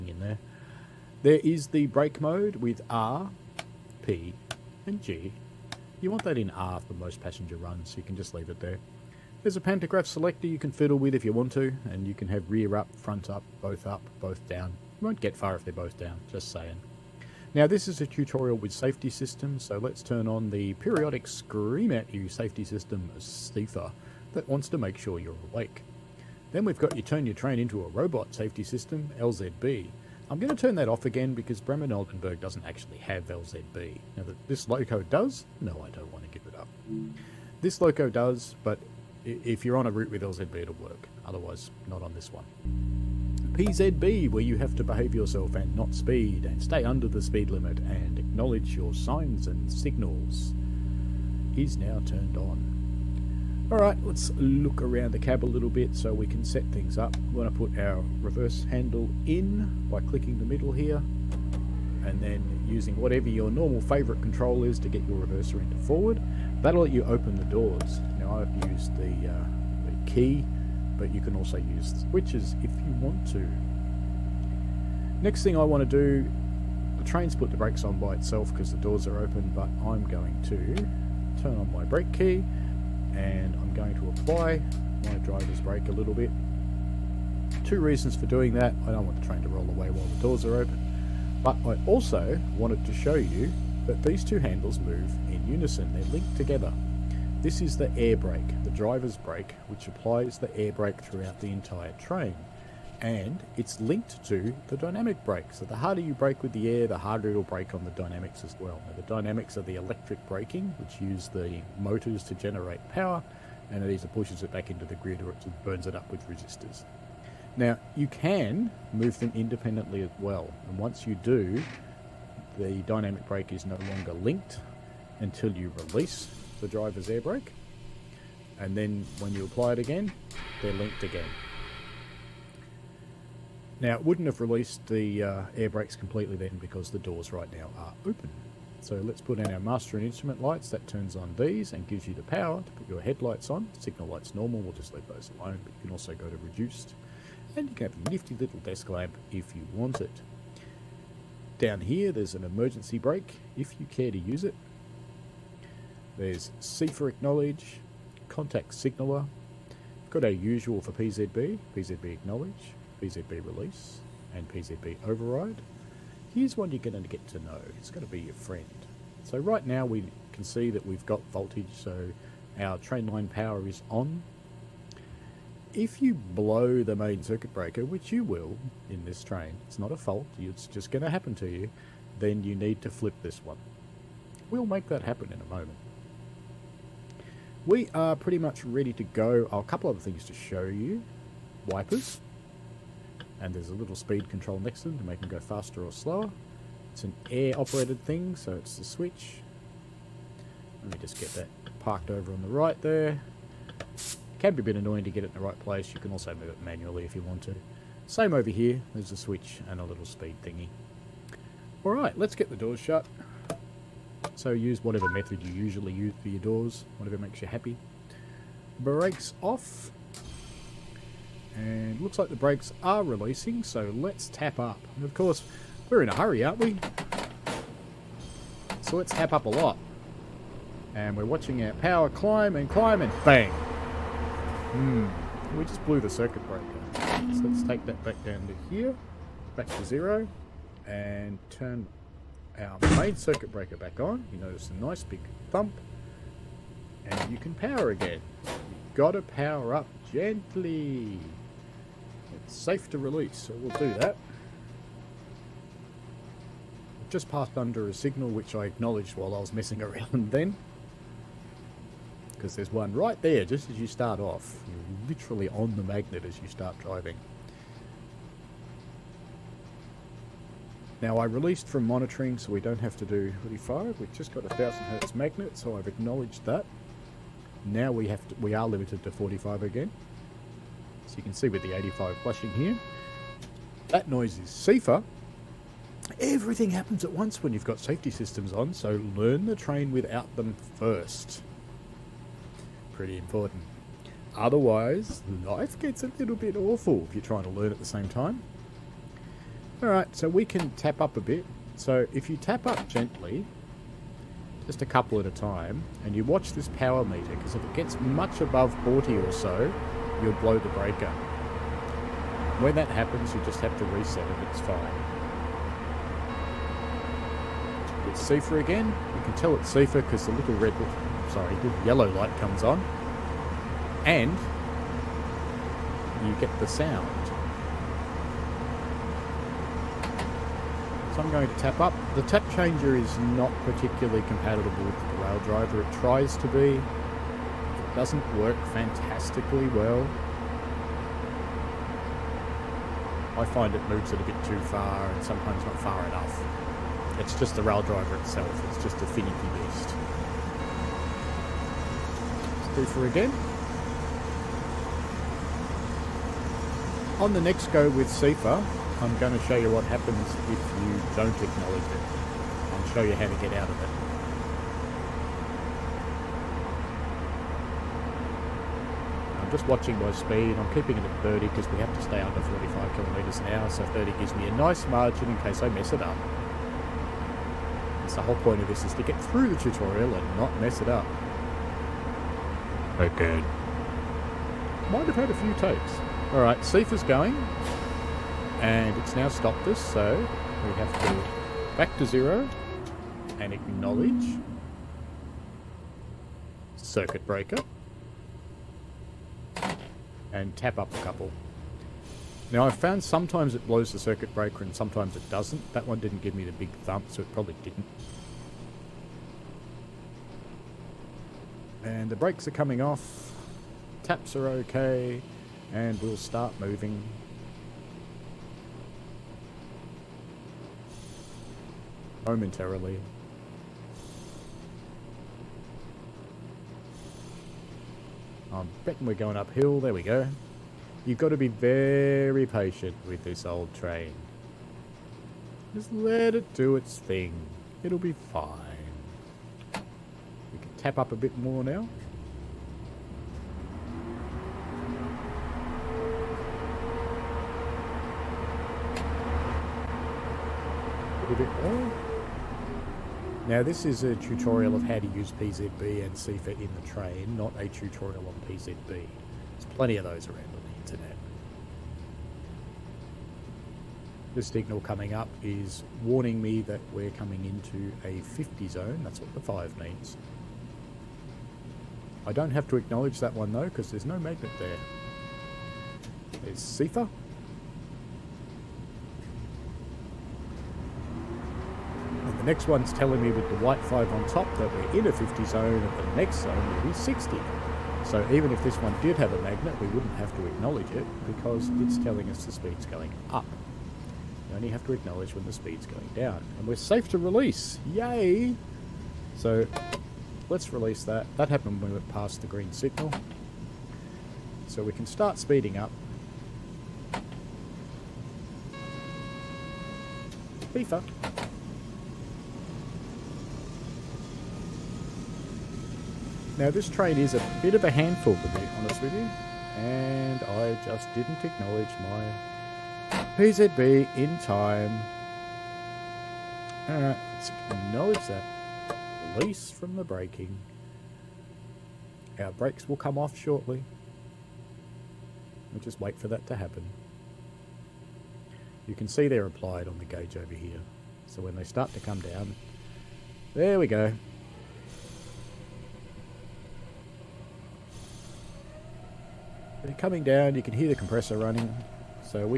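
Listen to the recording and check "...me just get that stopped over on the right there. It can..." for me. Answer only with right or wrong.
wrong.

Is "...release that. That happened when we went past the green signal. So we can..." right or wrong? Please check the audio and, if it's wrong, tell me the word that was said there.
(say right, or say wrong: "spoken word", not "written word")
right.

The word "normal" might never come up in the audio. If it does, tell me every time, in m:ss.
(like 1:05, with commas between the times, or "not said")
1:03, 2:24.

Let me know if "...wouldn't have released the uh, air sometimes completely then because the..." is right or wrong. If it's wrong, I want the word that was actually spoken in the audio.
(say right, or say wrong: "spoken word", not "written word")
wrong: "brakes", not "sometimes".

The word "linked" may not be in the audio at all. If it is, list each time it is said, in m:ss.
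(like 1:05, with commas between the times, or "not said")
1:36, 1:43, 2:04, 2:10.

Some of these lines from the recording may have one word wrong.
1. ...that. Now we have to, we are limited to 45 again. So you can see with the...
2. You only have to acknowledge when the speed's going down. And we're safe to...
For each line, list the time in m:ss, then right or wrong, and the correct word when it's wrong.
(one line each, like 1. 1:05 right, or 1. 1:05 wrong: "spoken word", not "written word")
1. 4:36 right
2. 8:14 right.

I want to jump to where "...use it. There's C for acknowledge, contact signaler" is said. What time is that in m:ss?
2:34.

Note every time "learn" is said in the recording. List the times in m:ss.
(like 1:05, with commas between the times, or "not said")
4:49, 4:57.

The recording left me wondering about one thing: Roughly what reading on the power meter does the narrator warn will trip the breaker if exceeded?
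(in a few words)
40.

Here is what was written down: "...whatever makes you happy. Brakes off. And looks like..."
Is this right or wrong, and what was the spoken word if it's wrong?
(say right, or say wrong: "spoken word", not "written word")
right.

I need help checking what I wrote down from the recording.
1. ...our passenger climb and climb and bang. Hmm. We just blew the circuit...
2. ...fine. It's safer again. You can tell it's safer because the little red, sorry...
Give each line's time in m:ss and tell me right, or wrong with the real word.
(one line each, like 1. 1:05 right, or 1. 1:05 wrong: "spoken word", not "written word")
1. 3:51 wrong: "power", not "passenger"
2. 5:14 right.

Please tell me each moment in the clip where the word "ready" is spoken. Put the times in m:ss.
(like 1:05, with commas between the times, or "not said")
3:08.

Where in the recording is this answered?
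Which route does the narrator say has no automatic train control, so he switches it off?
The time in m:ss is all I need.
0:31.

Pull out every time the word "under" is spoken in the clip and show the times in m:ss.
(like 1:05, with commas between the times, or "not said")
0:46, 4:17, 6:12.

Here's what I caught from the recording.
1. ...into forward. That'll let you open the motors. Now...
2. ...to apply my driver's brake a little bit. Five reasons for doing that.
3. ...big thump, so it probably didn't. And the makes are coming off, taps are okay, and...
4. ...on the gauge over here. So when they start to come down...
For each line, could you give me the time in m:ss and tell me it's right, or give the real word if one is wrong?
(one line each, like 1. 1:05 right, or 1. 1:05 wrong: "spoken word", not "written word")
1. 1:05 wrong: "doors", not "motors"
2. 1:23 wrong: "Two", not "Five"
3. 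6:46 wrong: "brakes", not "makes"
4. 8:59 right.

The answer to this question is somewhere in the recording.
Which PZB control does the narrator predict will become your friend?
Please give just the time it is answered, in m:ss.
2:44.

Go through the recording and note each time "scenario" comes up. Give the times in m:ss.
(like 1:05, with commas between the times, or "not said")
not said.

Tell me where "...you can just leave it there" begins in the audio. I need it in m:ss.
0:07.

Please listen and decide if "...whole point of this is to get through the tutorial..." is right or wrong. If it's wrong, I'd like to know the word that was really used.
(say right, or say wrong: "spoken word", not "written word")
right.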